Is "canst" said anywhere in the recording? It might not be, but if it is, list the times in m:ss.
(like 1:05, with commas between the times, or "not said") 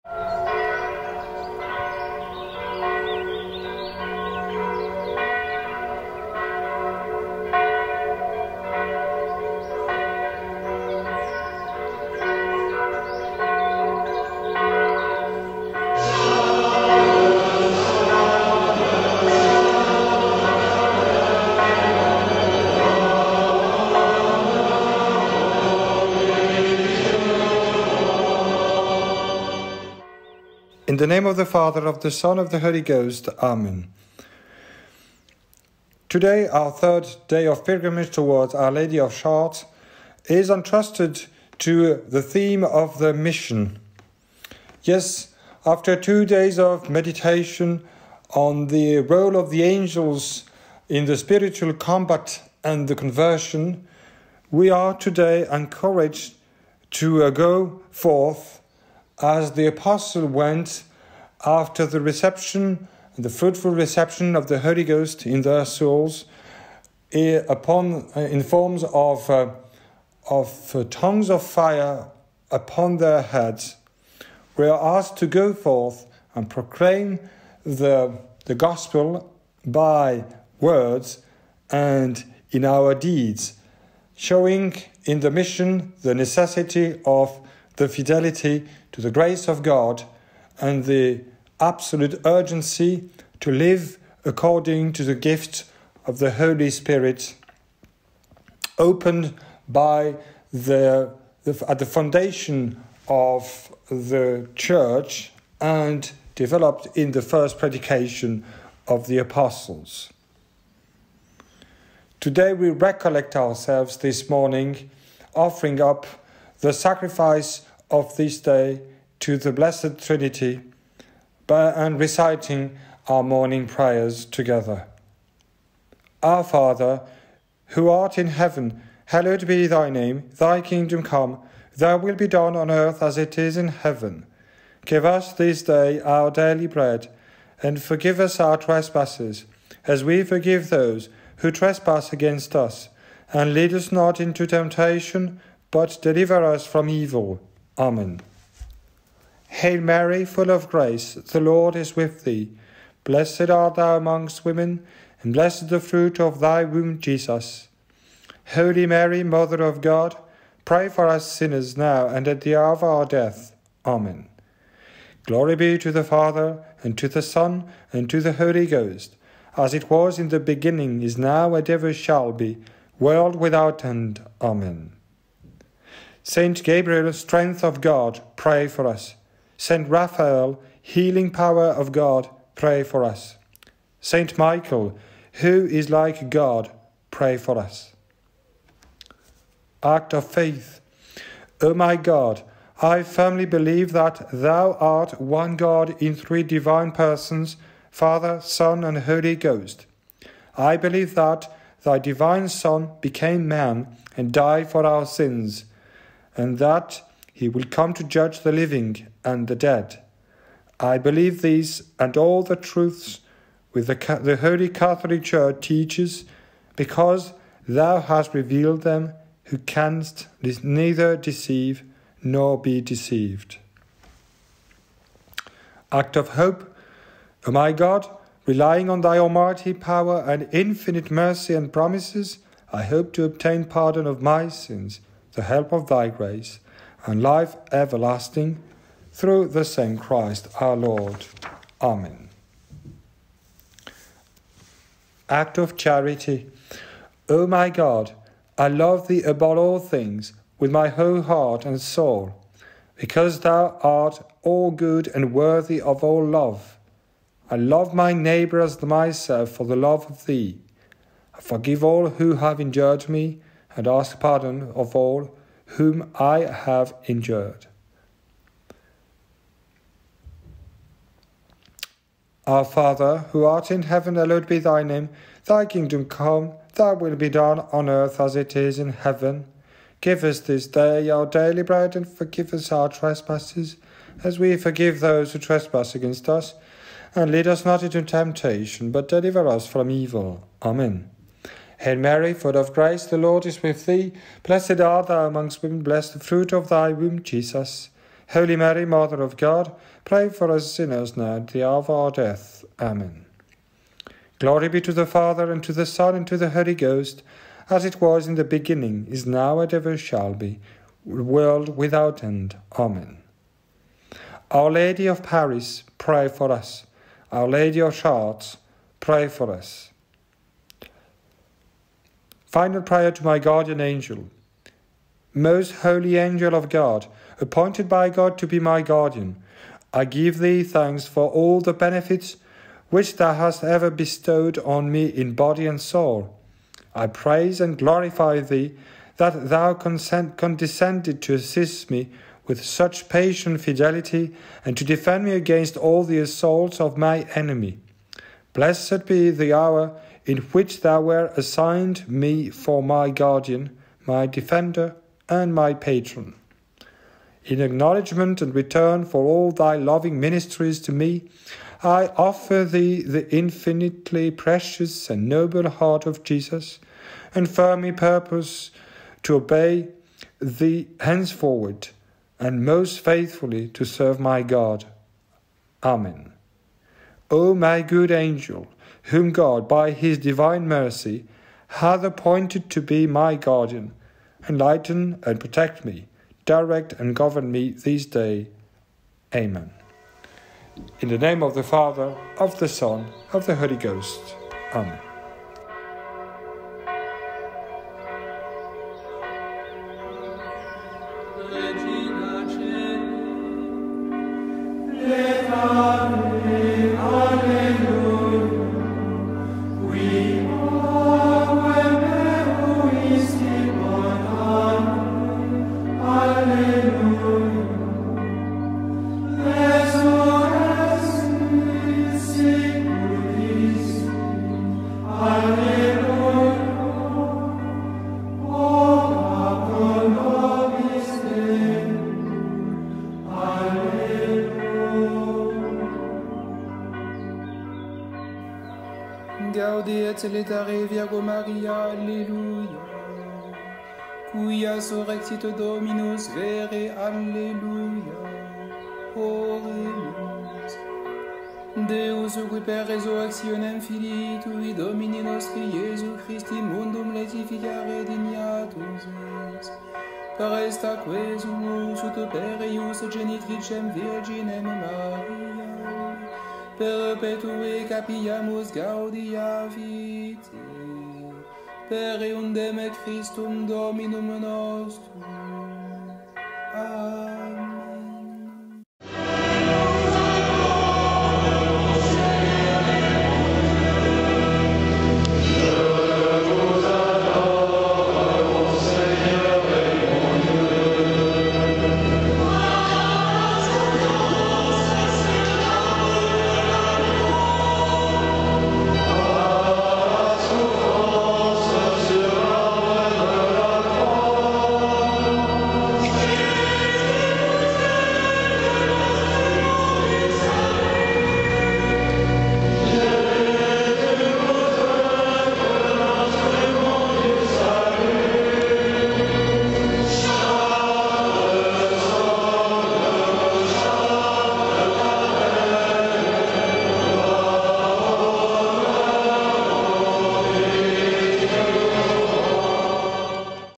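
3:39.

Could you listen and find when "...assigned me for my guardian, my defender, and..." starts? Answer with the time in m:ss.
5:51.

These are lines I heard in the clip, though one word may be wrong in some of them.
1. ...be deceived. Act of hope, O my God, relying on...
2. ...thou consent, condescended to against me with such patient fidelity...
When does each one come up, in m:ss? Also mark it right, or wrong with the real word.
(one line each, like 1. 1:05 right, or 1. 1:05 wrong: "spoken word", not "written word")
1. 3:42 right
2. 5:39 wrong: "assist", not "against".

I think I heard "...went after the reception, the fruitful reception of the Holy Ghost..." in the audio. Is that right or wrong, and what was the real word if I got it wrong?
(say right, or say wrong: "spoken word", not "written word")
right.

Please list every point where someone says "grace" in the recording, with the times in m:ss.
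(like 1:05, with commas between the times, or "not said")
1:29, 2:30, 3:56, 4:52.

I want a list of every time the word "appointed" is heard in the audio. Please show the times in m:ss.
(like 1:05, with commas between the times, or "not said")
5:27, 6:22.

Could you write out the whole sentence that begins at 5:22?
Final prayer to my guardian angel.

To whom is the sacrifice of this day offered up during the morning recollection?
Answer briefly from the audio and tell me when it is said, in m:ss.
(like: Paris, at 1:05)
The Blessed Trinity, at 1:59.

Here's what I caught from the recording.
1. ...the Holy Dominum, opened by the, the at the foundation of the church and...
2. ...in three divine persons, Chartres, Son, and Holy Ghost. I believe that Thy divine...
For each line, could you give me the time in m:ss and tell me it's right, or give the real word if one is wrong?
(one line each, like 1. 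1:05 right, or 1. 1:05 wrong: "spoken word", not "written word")
1. 1:36 wrong: "Spirit", not "Dominum"
2. 3:16 wrong: "Father", not "Chartres".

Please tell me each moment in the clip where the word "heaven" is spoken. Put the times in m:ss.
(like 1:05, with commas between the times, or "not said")
2:08, 2:13, 4:33, 4:38.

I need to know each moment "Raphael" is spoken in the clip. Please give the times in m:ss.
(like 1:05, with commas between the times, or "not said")
2:59.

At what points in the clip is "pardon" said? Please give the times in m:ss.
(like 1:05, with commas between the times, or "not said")
3:53, 4:24.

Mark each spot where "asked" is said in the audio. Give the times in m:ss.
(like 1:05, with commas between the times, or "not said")
1:14.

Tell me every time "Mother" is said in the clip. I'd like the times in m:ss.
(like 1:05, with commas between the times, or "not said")
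2:39, 4:58.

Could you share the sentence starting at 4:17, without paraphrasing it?
I love my neighbour as myself for the love of thee.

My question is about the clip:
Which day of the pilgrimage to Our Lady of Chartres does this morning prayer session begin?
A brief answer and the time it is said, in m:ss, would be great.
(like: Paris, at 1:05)
Third day, at 0:36.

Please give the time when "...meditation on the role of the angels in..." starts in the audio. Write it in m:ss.
0:46.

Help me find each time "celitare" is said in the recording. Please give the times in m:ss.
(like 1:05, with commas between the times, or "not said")
7:20.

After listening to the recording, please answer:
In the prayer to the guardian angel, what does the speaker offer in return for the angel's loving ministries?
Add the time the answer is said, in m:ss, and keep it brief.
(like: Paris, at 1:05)
Heart of Jesus, at 6:05.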